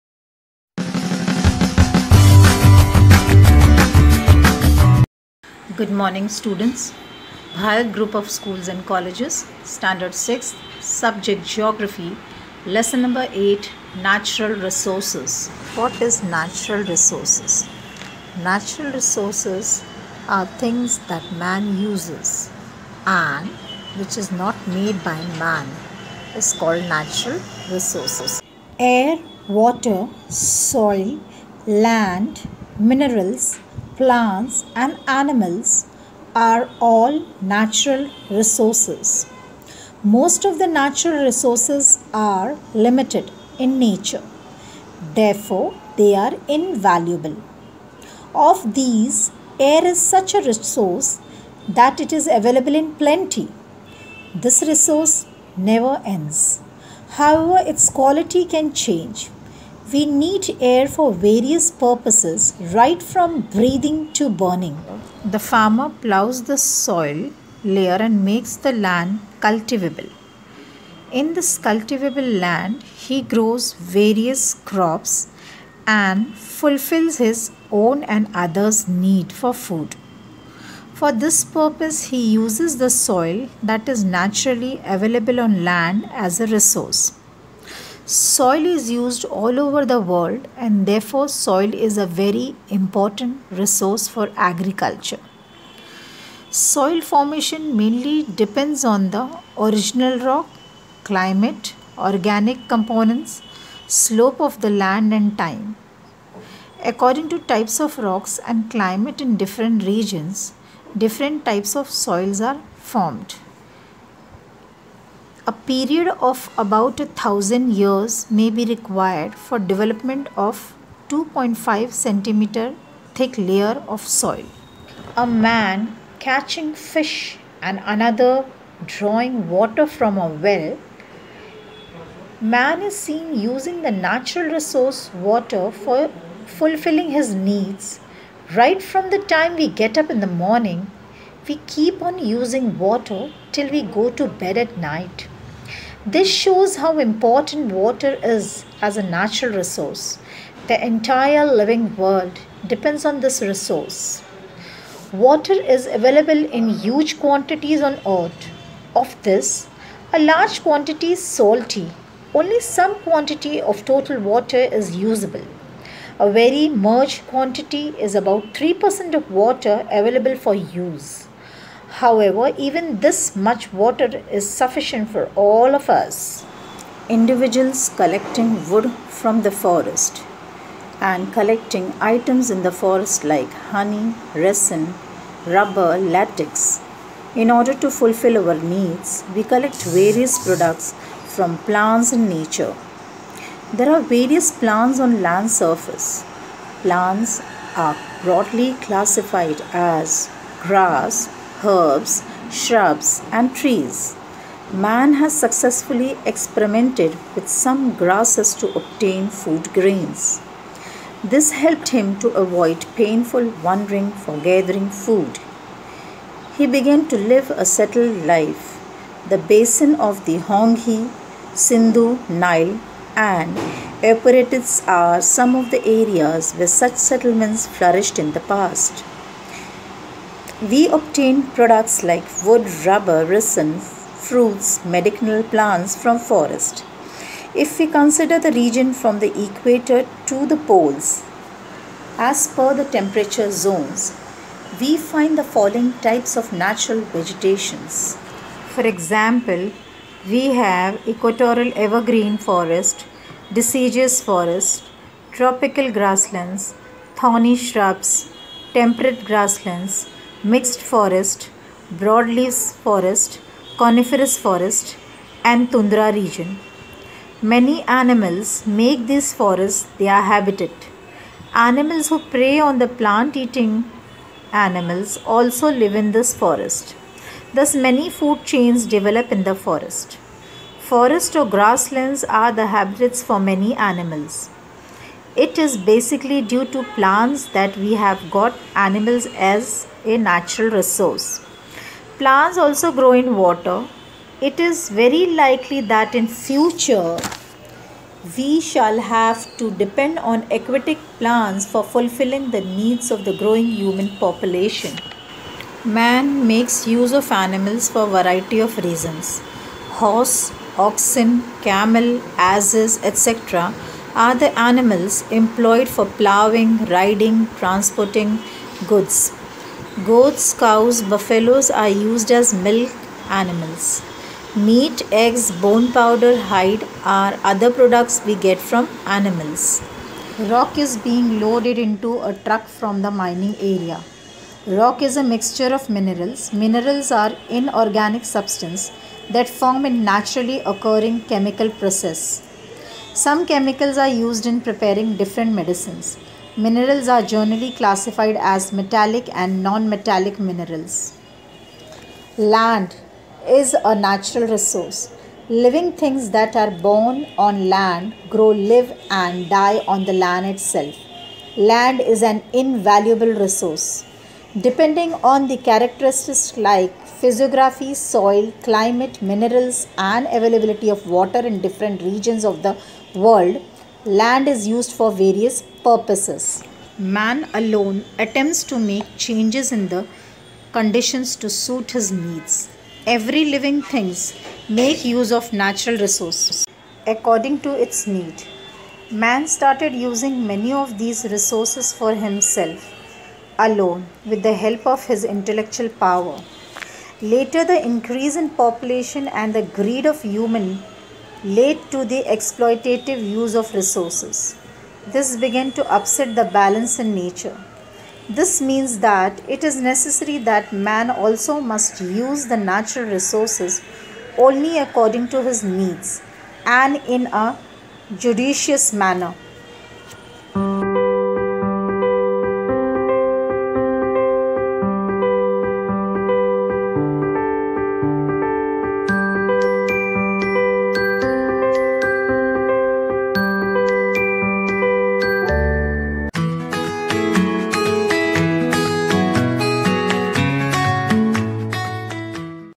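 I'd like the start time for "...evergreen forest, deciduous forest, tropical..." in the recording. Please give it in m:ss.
4:11.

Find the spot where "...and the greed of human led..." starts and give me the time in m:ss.
6:39.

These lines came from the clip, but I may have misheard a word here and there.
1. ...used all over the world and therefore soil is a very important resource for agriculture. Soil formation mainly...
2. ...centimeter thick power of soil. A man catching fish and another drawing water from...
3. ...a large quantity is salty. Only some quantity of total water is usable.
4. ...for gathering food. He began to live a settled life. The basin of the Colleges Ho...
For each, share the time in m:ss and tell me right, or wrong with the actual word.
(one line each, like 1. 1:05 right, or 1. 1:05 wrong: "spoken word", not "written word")
1. 1:28 right
2. 2:01 wrong: "layer", not "power"
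3. 2:40 right
4. 3:34 wrong: "Hwang", not "Colleges".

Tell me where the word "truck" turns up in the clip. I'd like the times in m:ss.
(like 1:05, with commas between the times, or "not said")
5:32.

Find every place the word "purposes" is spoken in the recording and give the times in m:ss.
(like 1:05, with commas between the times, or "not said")
1:01, 1:21, 6:15.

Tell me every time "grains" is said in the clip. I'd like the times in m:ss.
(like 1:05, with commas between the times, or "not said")
3:29.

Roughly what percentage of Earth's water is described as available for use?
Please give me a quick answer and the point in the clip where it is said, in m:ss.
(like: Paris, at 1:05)
3%, at 2:48.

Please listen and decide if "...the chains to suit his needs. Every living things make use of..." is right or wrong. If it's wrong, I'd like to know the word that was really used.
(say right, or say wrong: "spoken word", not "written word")
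wrong: "conditions", not "chains".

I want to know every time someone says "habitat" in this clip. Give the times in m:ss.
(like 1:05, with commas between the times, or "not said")
4:30, 4:42.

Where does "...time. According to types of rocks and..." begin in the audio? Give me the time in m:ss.
1:45.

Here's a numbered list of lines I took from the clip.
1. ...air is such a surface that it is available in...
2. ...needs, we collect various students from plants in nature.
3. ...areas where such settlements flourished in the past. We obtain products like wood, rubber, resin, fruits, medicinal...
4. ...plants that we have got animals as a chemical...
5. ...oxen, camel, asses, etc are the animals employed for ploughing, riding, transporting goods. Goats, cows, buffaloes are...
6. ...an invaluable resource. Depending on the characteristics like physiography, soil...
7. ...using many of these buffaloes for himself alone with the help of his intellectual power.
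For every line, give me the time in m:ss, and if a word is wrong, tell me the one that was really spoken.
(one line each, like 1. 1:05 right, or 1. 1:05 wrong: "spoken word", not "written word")
1. 0:49 wrong: "resource", not "surface"
2. 3:08 wrong: "products", not "students"
3. 3:45 right
4. 4:46 wrong: "natural", not "chemical"
5. 5:10 right
6. 6:02 right
7. 6:29 wrong: "resources", not "buffaloes".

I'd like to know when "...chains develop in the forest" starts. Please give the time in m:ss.
4:38.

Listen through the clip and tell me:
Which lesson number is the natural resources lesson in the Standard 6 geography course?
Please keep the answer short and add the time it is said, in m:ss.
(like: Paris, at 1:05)
8, at 0:12.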